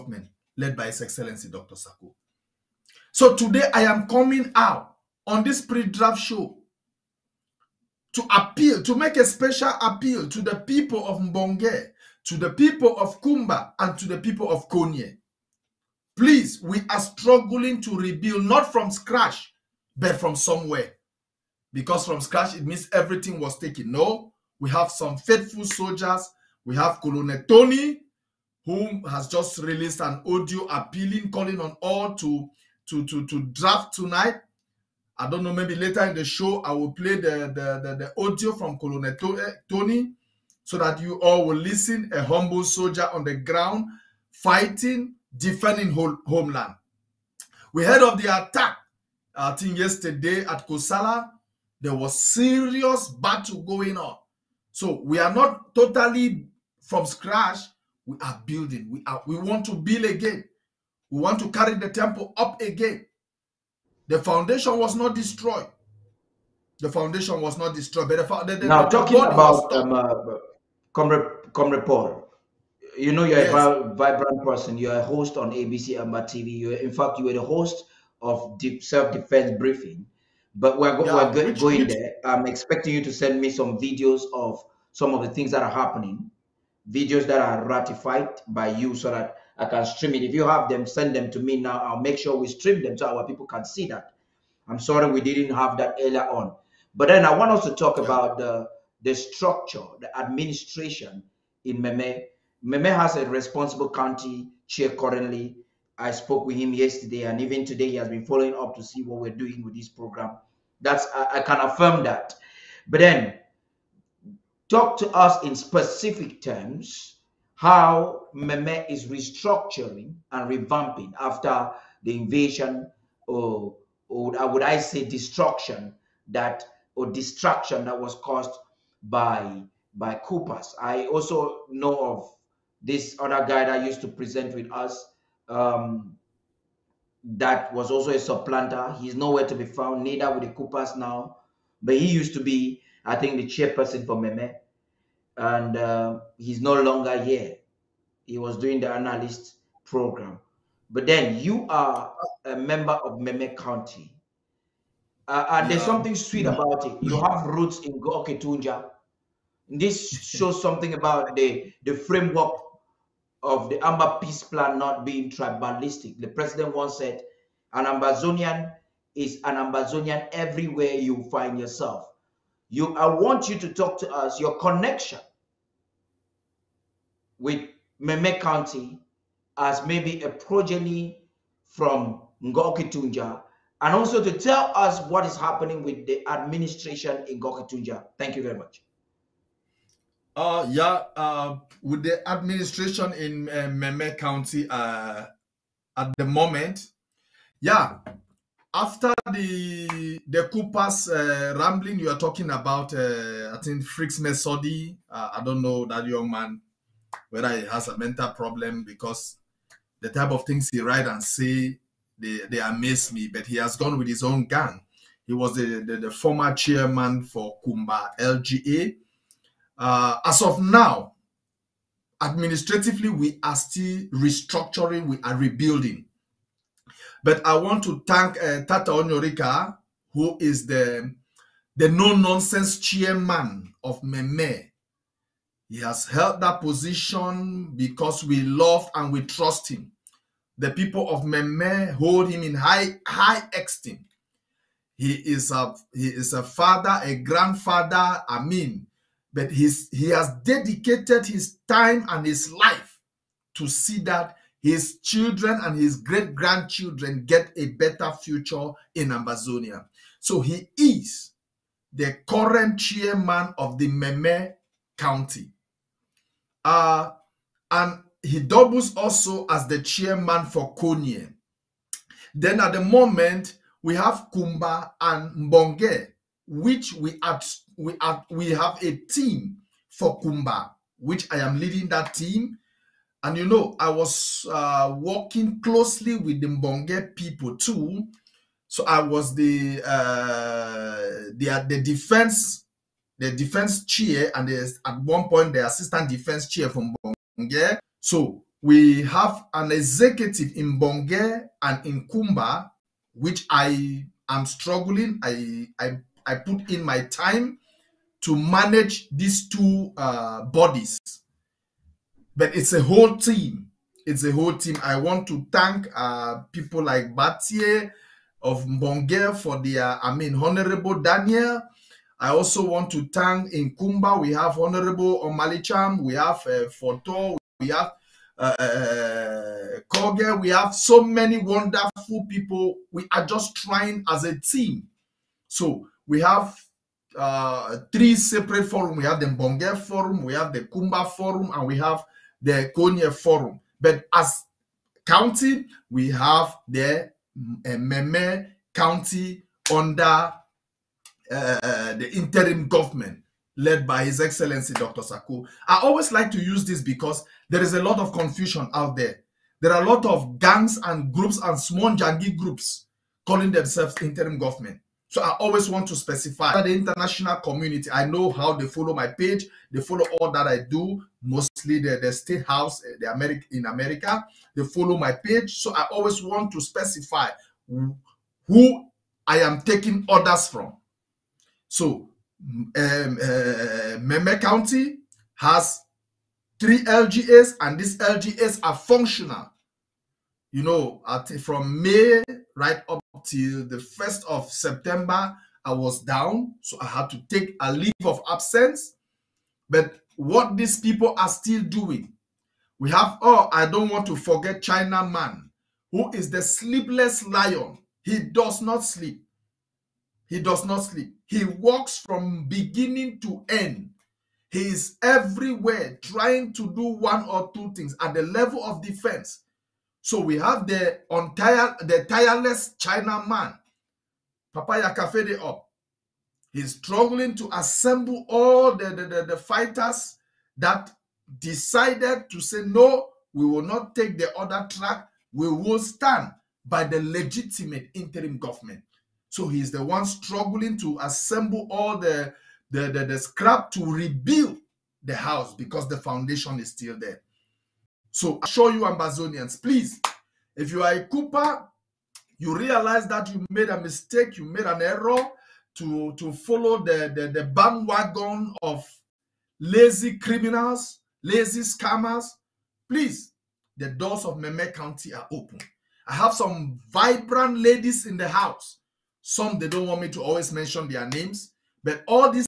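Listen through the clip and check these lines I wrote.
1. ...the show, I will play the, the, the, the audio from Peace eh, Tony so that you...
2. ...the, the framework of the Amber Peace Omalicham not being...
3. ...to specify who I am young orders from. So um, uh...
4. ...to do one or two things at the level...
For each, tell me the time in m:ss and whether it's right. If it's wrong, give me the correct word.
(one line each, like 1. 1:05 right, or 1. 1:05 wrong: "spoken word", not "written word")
1. 0:36 wrong: "Colonel", not "Peace"
2. 2:41 wrong: "Plan", not "Omalicham"
3. 6:16 wrong: "taking", not "young"
4. 6:56 right.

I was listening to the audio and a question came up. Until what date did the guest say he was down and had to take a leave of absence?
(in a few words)
1st of September.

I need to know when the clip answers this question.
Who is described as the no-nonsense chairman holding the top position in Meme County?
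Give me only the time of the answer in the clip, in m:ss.
3:48.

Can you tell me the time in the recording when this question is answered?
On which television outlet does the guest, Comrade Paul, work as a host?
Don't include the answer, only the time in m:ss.
1:15.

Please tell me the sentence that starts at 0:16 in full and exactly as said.
Please, we are struggling to rebuild, not from scratch, but from somewhere.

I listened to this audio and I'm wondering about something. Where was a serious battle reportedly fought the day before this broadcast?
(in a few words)
Kosala.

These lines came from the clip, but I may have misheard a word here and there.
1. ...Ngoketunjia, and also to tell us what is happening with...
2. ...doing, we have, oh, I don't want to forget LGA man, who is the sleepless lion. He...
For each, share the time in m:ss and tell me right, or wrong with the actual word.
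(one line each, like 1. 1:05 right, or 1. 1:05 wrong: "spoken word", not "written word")
1. 3:02 right
2. 6:41 wrong: "China", not "LGA".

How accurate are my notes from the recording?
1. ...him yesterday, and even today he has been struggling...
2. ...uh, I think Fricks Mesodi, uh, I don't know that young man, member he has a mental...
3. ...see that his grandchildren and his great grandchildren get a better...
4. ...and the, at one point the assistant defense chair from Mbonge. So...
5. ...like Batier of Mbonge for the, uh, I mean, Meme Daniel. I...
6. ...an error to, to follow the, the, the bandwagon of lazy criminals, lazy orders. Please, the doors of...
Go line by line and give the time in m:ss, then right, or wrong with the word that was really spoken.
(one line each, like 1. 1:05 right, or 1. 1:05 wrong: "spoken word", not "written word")
1. 1:46 wrong: "following", not "struggling"
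2. 3:22 wrong: "whether", not "member"
3. 4:13 wrong: "children", not "grandchildren"
4. 4:54 right
5. 5:16 wrong: "Honorable", not "Meme"
6. 7:34 wrong: "scammers", not "orders".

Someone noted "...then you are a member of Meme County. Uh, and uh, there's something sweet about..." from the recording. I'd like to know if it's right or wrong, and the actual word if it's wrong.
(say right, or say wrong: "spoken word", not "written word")
right.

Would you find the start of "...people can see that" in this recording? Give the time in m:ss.
1:33.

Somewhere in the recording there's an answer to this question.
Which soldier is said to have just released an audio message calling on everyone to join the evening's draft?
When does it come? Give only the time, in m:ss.
0:27.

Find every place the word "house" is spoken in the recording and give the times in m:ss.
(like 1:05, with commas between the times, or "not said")
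6:12, 7:25, 7:48.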